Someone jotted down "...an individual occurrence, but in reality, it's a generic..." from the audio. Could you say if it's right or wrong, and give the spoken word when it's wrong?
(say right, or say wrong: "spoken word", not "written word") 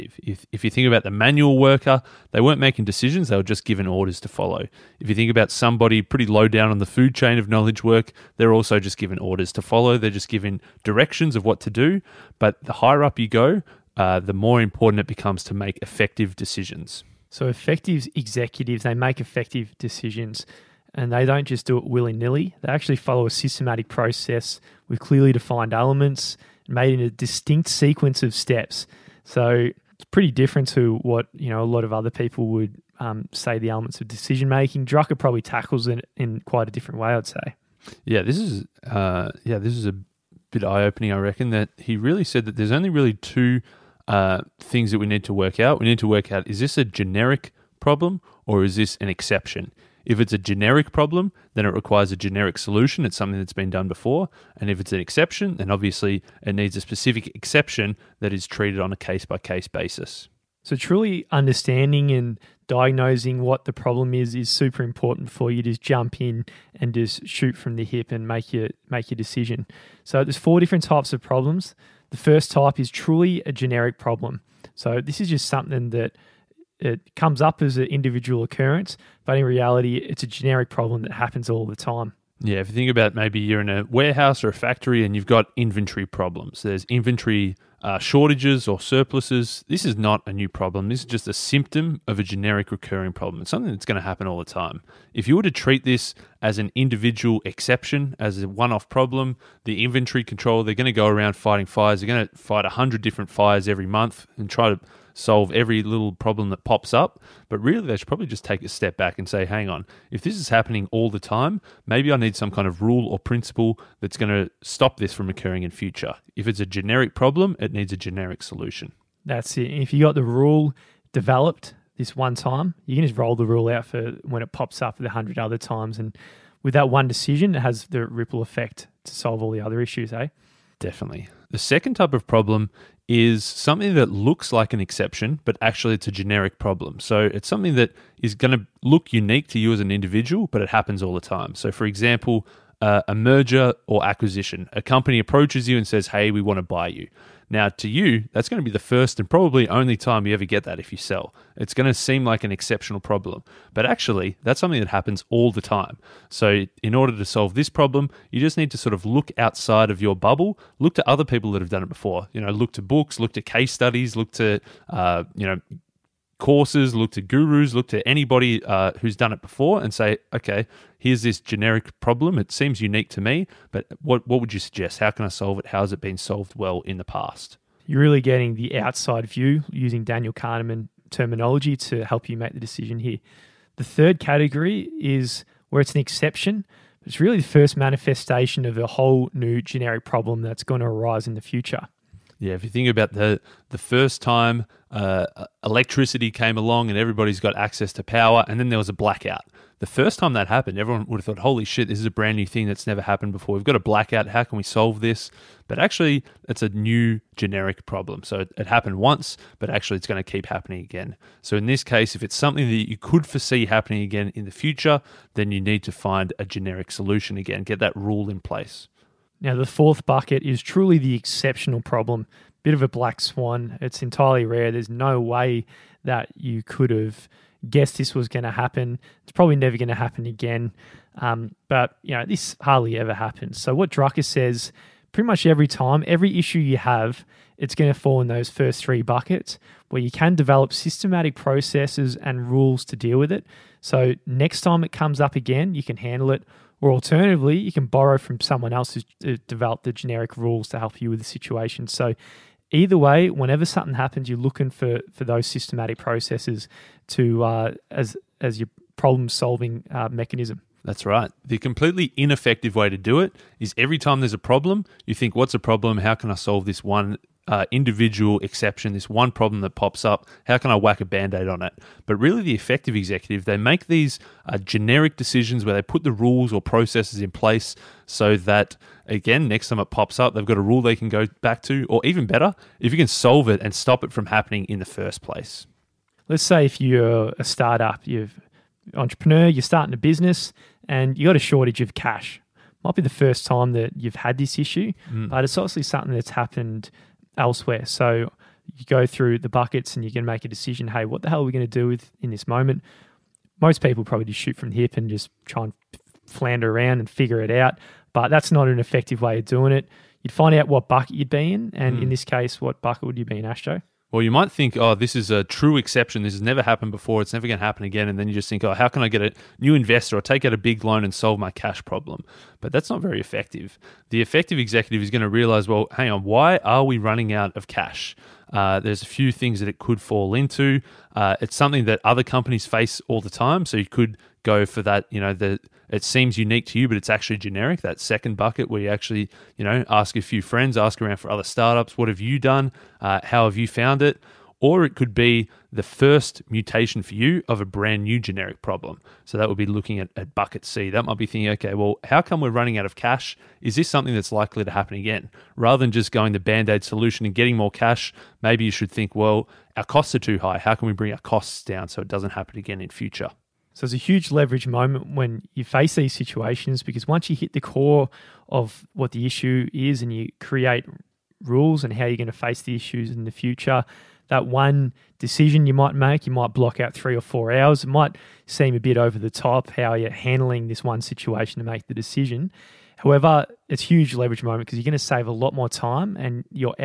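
right.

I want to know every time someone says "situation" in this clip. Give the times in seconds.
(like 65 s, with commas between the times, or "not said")
251 s, 366 s, 380 s.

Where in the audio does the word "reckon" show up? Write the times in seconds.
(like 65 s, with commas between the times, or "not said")
41 s.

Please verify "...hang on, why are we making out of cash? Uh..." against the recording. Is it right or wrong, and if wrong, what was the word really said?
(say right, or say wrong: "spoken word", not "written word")
wrong: "running", not "making".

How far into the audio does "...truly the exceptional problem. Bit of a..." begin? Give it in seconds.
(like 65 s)
220 s.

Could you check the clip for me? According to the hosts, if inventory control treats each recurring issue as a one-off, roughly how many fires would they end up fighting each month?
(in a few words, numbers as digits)
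100.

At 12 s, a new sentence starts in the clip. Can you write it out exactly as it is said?
But the higher up you go, uh, the more important it becomes to make effective decisions.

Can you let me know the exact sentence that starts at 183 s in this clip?
The third category is where it's an exception.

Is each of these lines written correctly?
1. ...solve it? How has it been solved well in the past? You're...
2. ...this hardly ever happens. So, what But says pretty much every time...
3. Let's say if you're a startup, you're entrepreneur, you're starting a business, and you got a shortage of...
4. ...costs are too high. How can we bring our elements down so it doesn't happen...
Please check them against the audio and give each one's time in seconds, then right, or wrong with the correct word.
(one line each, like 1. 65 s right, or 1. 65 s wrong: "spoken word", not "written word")
1. 175 s right
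2. 232 s wrong: "Drucker", not "But"
3. 286 s right
4. 359 s wrong: "costs", not "elements".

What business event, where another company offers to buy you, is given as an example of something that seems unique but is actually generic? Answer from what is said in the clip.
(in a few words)
Merger or acquisition.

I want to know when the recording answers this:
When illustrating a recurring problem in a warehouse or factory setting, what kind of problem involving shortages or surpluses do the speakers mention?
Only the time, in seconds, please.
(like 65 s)
85 s.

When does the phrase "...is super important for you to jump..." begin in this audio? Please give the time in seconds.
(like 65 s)
64 s.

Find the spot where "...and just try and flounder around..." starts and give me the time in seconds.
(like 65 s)
304 s.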